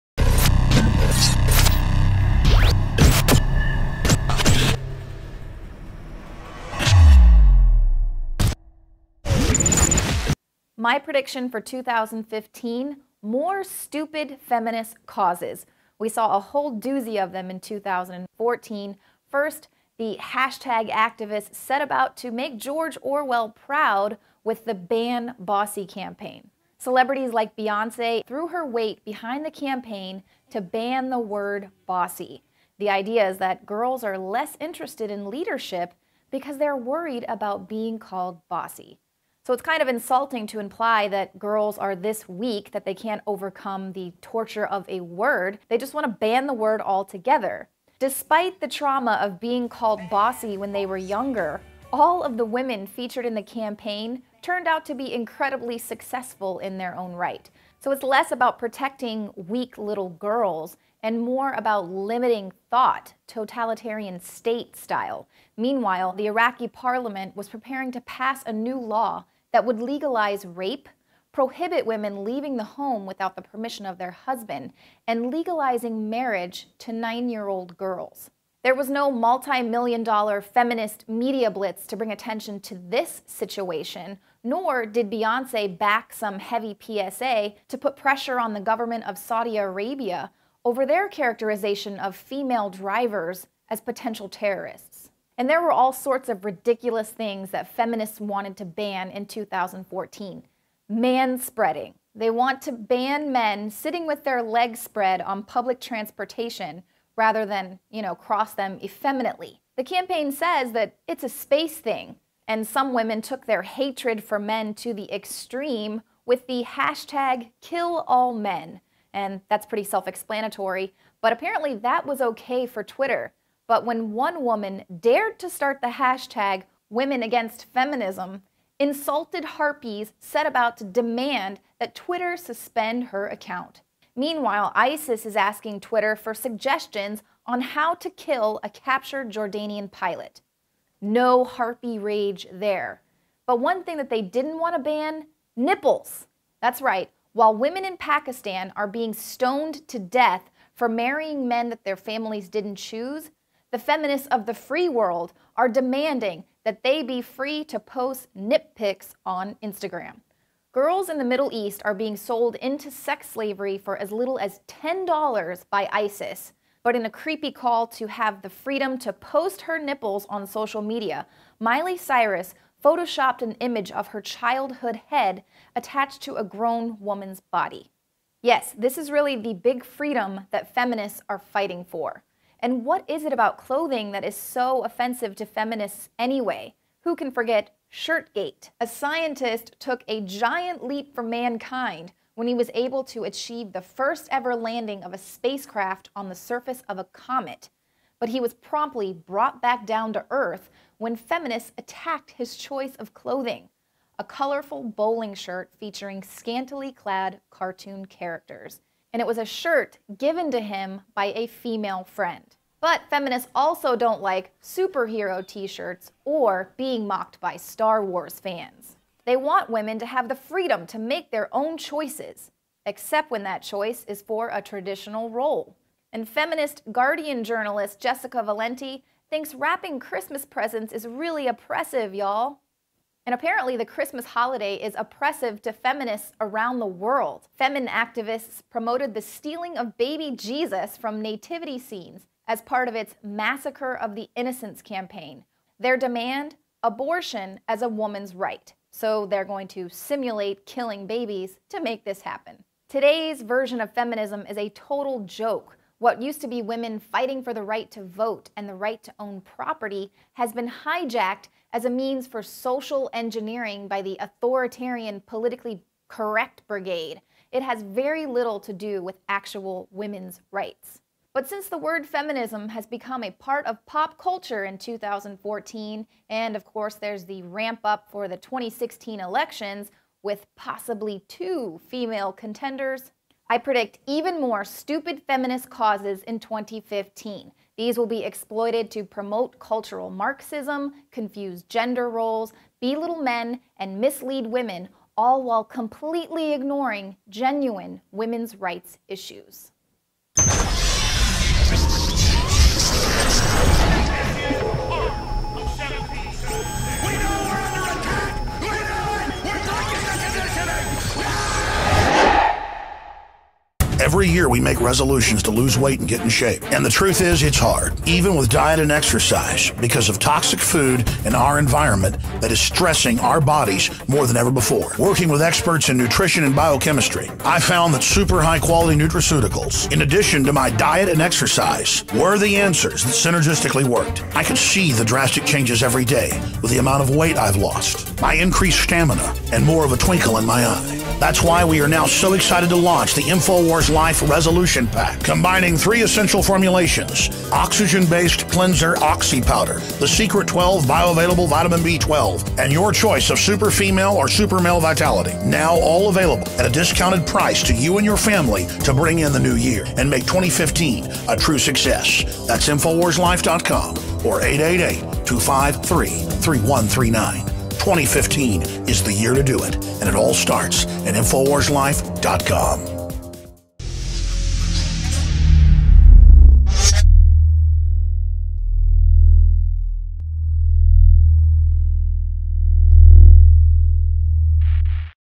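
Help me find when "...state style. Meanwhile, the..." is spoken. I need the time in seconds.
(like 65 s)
64 s.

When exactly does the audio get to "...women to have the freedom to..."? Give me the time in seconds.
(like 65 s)
219 s.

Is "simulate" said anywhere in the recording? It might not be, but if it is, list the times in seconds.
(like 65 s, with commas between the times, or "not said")
249 s.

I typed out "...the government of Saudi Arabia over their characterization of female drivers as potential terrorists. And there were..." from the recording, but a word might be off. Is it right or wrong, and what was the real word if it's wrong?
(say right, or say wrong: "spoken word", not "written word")
right.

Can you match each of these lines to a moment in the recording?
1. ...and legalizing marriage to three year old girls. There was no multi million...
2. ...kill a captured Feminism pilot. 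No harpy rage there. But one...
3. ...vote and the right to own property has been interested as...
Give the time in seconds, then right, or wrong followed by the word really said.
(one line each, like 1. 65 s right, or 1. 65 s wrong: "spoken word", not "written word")
1. 75 s wrong: "nine", not "three"
2. 138 s wrong: "Jordanian", not "Feminism"
3. 258 s wrong: "hijacked", not "interested".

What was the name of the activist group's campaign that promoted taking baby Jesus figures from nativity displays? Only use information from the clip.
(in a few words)
Massacre of the Innocents.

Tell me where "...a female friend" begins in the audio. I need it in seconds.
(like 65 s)
211 s.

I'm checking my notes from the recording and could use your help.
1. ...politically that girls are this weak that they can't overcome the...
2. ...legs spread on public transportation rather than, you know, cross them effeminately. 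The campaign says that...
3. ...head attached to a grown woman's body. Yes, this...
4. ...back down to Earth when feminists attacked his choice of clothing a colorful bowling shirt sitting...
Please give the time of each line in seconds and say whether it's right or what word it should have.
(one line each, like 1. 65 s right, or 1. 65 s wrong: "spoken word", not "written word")
1. 40 s wrong: "imply", not "politically"
2. 104 s right
3. 175 s right
4. 199 s wrong: "featuring", not "sitting".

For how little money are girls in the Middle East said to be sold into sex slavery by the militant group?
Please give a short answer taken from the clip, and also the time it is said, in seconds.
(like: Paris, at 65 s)
$10, at 164 s.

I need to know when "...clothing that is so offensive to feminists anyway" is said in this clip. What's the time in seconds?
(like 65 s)
183 s.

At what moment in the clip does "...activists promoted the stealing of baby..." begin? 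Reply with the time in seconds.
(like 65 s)
237 s.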